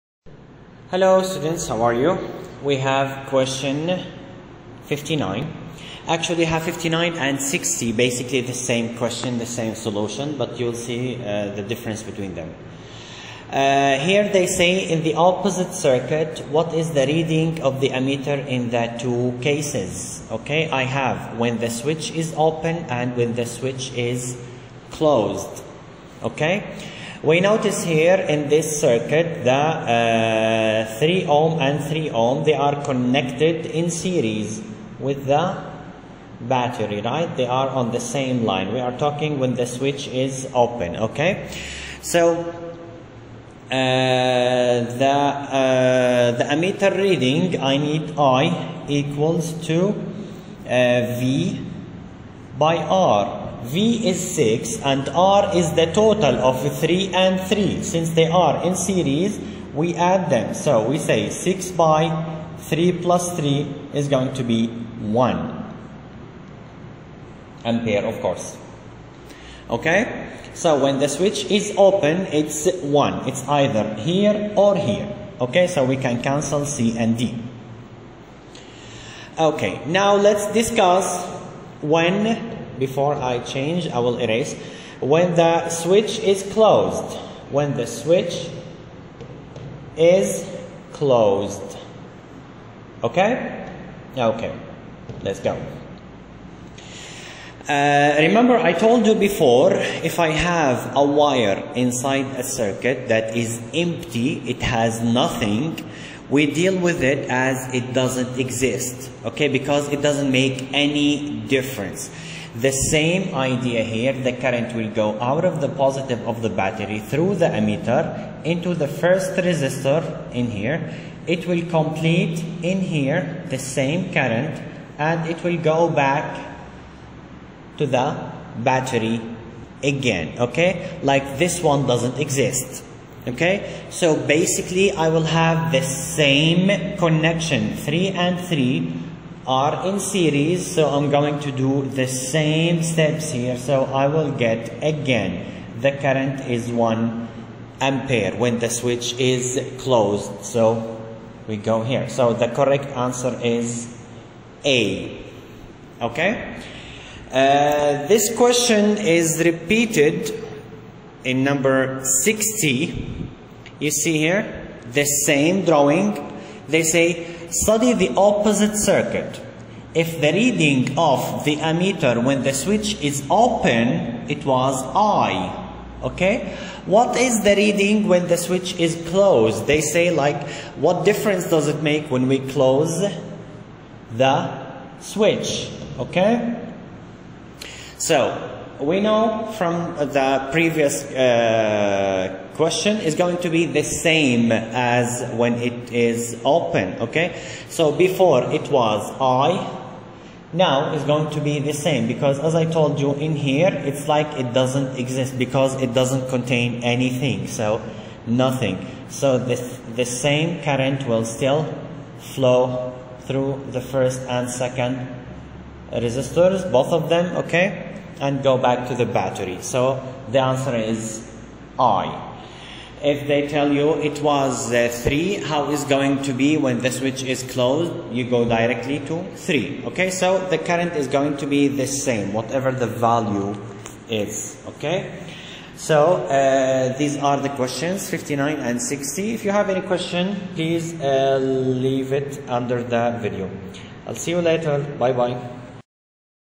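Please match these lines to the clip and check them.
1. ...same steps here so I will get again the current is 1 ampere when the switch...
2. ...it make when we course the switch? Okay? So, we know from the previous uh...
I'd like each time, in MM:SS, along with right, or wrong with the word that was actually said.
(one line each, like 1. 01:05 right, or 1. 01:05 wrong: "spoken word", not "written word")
1. 02:22 right
2. 03:01 wrong: "close", not "course".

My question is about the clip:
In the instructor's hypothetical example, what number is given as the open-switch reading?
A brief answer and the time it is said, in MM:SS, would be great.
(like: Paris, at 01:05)
3, at 03:43.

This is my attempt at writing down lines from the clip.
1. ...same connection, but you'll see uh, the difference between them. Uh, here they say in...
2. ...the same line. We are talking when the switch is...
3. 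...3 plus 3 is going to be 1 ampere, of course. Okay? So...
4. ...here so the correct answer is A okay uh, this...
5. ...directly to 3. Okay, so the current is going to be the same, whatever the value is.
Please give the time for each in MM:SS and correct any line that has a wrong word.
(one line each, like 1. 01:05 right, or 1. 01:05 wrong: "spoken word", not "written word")
1. 00:09 wrong: "solution", not "connection"
2. 00:37 right
3. 01:02 right
4. 02:31 right
5. 03:48 right.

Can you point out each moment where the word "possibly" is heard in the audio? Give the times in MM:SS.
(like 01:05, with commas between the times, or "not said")
not said.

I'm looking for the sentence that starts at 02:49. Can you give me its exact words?
If the reading of the ammeter when the switch is open, it was I.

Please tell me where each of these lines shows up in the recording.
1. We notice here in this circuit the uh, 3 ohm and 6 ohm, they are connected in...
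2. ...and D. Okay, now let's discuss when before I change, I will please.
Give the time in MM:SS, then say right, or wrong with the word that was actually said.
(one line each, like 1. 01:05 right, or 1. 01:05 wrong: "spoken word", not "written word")
1. 00:27 wrong: "3", not "6"
2. 01:16 wrong: "erase", not "please".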